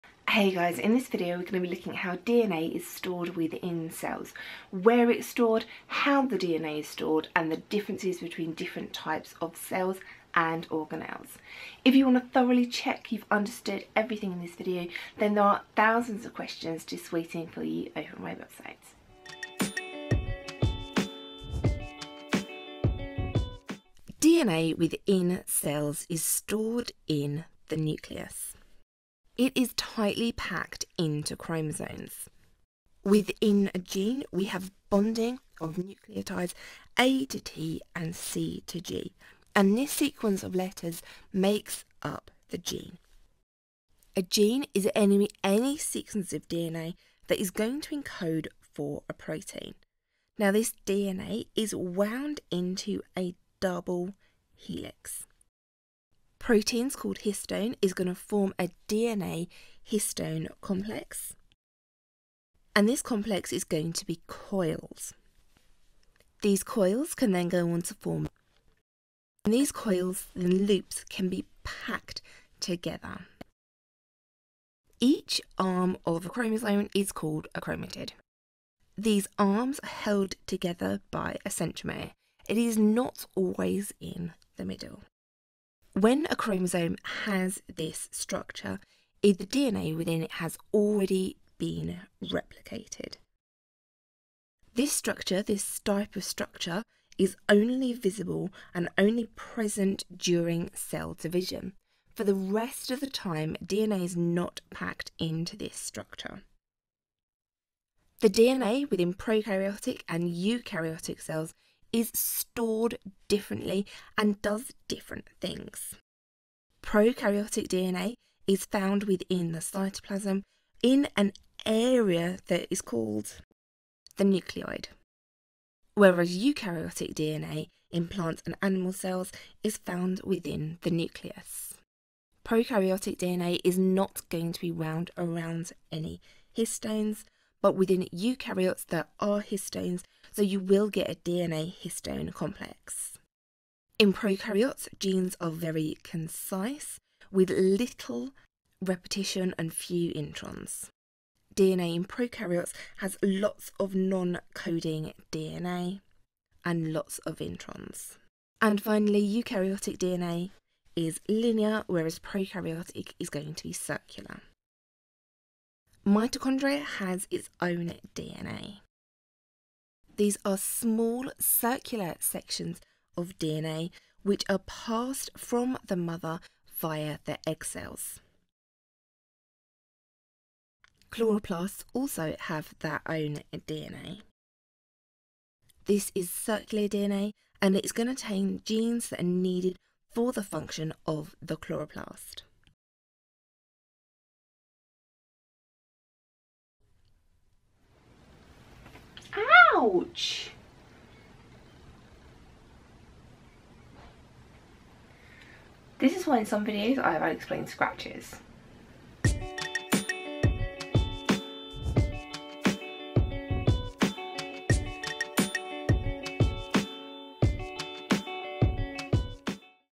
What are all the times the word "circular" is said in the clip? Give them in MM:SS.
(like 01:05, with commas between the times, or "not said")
02:43, 02:51, 03:06.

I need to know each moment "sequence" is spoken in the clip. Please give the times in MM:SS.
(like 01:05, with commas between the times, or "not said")
00:39, 00:45.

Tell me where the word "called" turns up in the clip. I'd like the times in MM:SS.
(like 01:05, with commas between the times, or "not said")
00:56, 01:17, 02:02.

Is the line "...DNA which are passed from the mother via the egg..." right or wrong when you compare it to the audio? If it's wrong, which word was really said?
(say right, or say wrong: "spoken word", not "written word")
right.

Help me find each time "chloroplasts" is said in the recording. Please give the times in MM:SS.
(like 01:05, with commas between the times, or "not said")
03:01, 03:11.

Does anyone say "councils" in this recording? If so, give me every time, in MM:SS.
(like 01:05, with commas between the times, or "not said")
not said.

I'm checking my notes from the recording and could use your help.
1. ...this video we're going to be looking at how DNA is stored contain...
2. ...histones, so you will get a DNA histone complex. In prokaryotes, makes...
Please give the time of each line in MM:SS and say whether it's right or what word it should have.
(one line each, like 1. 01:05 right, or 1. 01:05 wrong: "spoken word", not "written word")
1. 00:00 wrong: "within", not "contain"
2. 02:19 wrong: "genes", not "makes".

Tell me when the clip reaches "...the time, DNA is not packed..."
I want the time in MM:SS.
01:43.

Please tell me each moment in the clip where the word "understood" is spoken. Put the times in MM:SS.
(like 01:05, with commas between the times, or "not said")
00:13.